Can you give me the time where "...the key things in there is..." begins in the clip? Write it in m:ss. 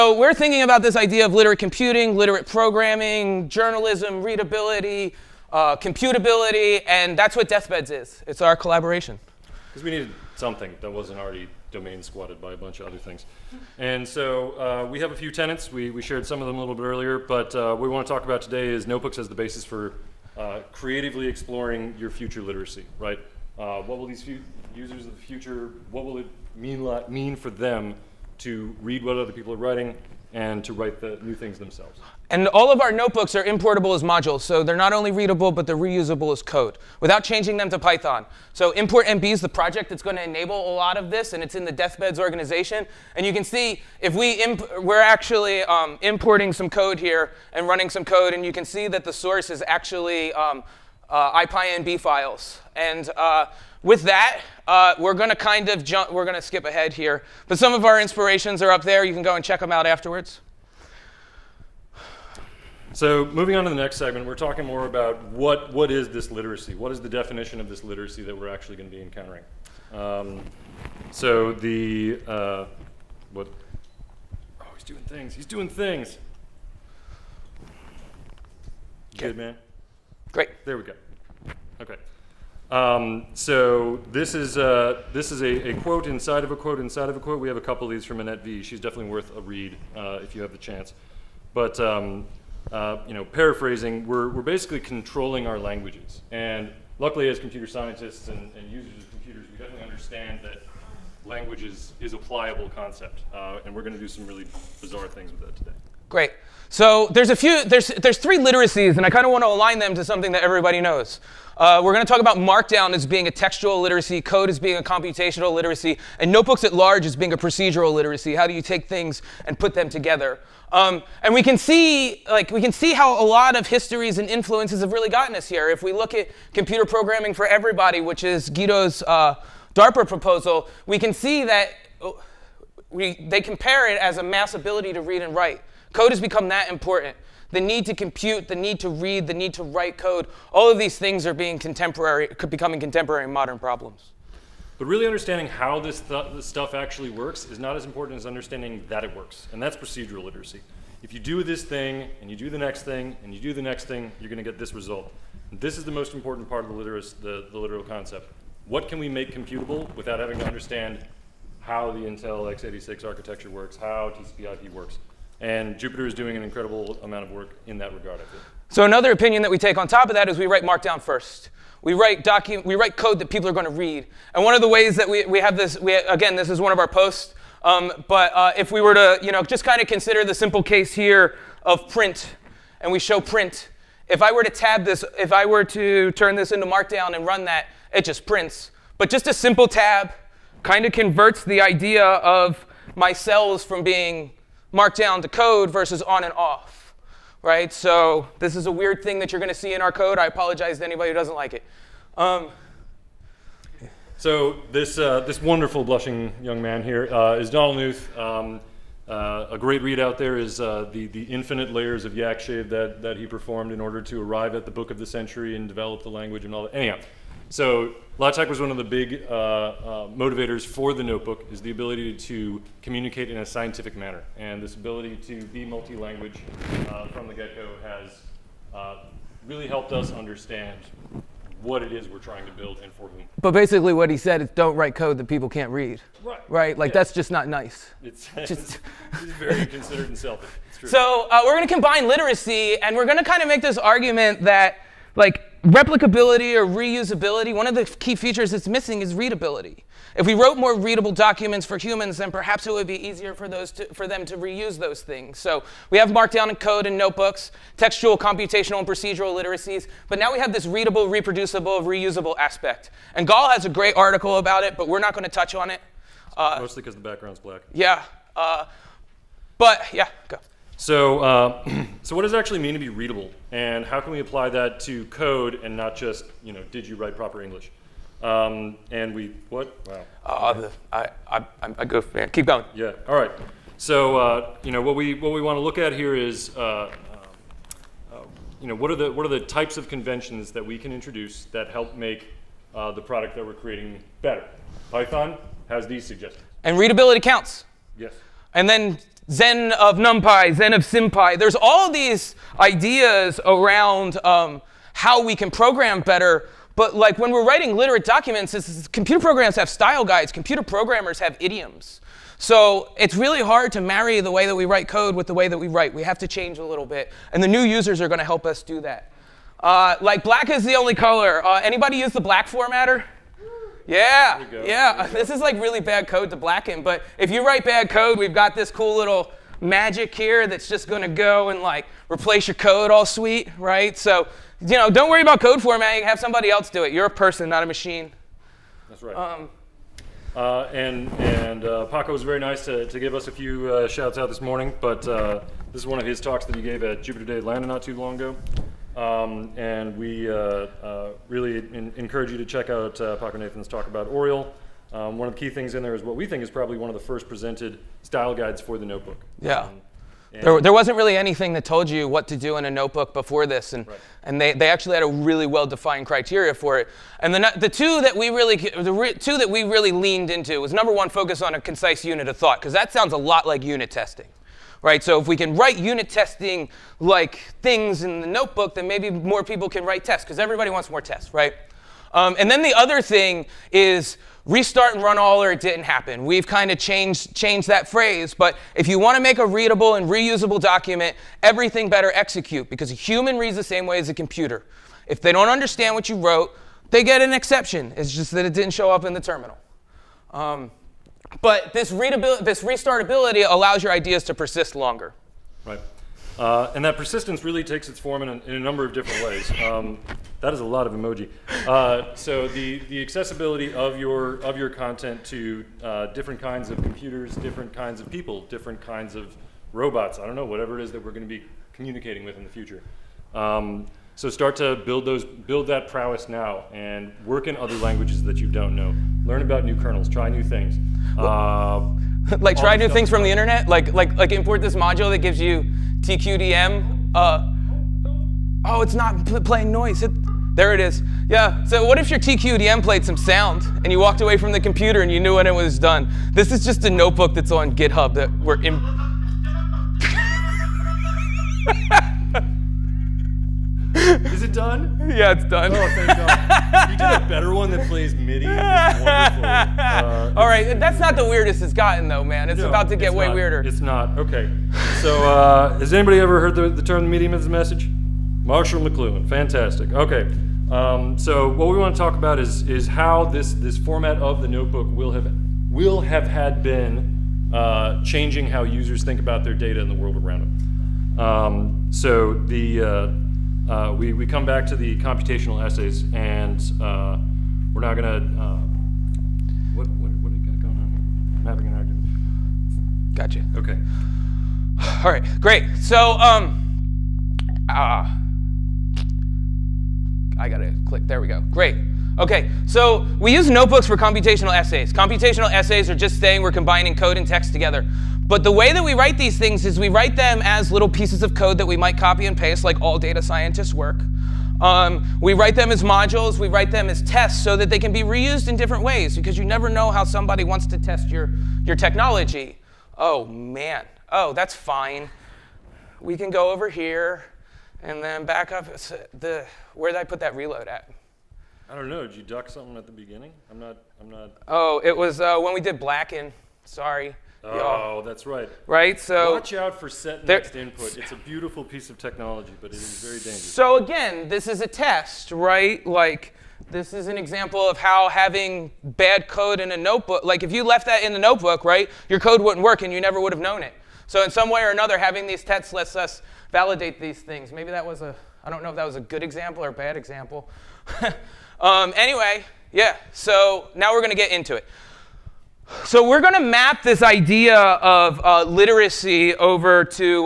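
5:55.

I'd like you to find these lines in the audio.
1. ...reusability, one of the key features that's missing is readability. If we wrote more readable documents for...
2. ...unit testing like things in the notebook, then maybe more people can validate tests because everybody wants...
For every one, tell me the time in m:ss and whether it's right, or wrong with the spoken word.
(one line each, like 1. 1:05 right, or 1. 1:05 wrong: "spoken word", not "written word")
1. 4:06 right
2. 6:15 wrong: "write", not "validate".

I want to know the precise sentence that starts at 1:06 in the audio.
What is the definition of this literacy that we're actually going to be encountering?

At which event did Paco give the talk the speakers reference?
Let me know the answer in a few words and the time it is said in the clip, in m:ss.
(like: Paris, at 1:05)
Jupyter Day Atlanta, at 5:47.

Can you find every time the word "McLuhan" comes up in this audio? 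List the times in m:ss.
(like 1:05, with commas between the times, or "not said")
7:48.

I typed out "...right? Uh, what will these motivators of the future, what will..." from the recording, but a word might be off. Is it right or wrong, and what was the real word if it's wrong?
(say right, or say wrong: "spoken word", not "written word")
wrong: "users", not "motivators".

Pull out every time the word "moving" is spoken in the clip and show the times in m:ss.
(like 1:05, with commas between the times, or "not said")
1:03.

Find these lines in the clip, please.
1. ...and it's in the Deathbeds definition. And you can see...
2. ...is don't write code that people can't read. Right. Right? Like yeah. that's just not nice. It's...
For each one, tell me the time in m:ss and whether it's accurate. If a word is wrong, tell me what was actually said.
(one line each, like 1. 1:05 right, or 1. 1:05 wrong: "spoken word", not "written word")
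1. 0:41 wrong: "organization", not "definition"
2. 3:54 right.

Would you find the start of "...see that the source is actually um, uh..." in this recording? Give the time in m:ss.
0:48.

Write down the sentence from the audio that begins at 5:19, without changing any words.
Uh, like black is the only color.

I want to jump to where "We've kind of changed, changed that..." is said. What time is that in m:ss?
6:26.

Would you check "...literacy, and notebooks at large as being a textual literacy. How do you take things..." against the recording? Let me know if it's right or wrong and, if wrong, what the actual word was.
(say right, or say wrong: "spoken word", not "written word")
wrong: "procedural", not "textual".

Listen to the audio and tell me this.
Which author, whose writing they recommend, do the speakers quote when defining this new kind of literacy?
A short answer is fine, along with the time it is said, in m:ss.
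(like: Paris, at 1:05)
Annette Vee, at 1:28.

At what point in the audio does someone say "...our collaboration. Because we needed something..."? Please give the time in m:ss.
0:08.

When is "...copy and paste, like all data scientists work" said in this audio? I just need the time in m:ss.
8:31.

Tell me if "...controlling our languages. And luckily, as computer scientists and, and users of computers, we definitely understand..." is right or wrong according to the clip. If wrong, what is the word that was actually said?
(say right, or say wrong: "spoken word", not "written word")
right.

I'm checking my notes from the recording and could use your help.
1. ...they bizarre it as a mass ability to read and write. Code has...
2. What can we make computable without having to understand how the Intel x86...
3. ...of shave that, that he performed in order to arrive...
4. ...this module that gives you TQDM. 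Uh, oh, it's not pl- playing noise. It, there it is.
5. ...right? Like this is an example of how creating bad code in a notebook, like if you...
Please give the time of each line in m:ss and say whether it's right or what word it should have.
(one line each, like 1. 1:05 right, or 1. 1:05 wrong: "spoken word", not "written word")
1. 2:13 wrong: "compare", not "bizarre"
2. 2:38 right
3. 3:32 right
4. 7:14 right
5. 9:05 wrong: "having", not "creating".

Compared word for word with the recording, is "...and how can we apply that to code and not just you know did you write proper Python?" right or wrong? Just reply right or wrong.
wrong.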